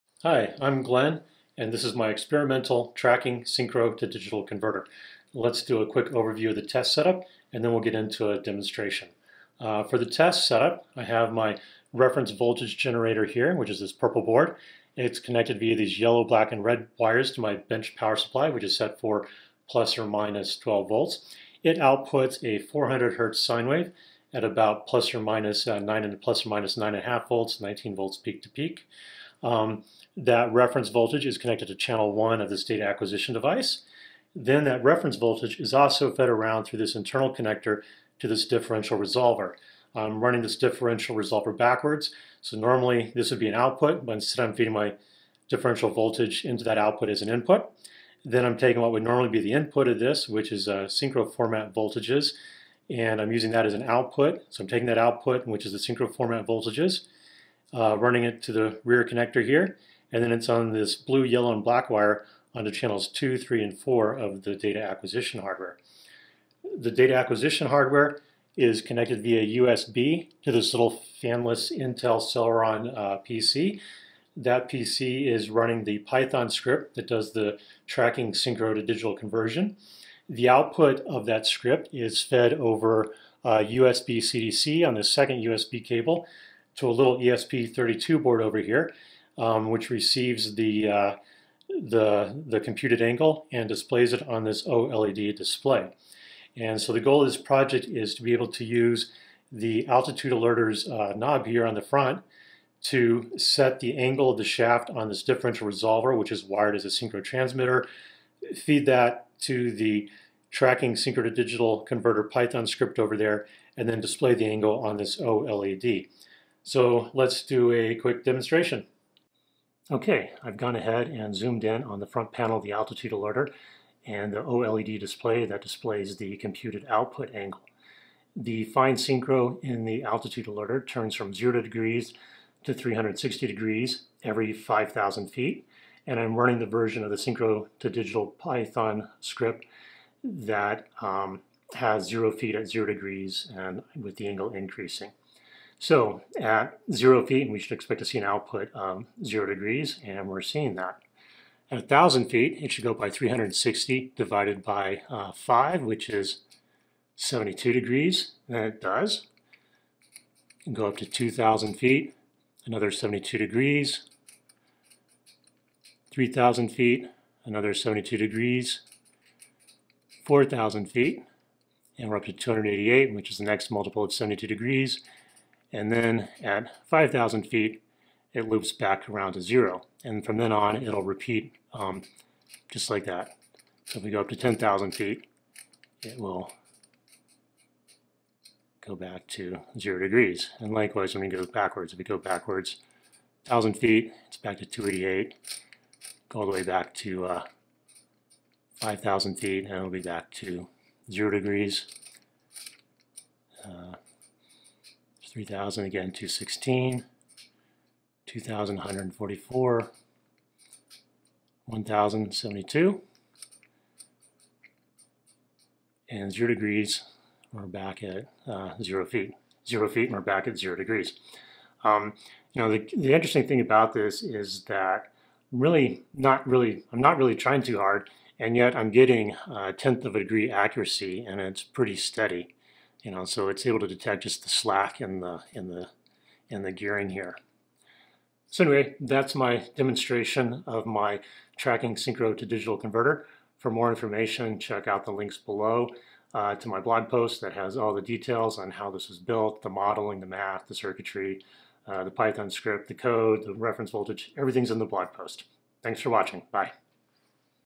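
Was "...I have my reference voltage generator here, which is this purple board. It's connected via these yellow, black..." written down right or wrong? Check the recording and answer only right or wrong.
right.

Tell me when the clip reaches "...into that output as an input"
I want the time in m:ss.
0:46.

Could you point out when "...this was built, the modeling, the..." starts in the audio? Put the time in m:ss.
4:08.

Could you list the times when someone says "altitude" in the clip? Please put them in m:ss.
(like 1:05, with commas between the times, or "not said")
1:39, 2:02, 2:10.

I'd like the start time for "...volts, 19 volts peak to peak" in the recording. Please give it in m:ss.
0:27.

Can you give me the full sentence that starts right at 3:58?
So anyway, that's my demonstration of my tracking synchro to digital converter.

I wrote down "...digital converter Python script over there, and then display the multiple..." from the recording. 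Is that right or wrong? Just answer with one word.
wrong.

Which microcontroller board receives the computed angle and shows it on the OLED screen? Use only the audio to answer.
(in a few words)
ESP32.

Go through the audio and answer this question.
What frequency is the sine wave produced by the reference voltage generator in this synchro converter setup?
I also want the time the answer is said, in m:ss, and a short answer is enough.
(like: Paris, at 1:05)
400 hertz, at 0:22.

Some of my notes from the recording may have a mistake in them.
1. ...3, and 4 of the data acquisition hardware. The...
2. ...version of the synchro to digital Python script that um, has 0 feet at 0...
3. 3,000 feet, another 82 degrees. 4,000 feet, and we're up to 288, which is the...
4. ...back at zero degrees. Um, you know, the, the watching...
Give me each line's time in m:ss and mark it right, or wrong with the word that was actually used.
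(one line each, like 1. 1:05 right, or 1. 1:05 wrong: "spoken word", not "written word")
1. 1:03 right
2. 2:16 right
3. 2:46 wrong: "72", not "82"
4. 3:40 wrong: "interesting", not "watching".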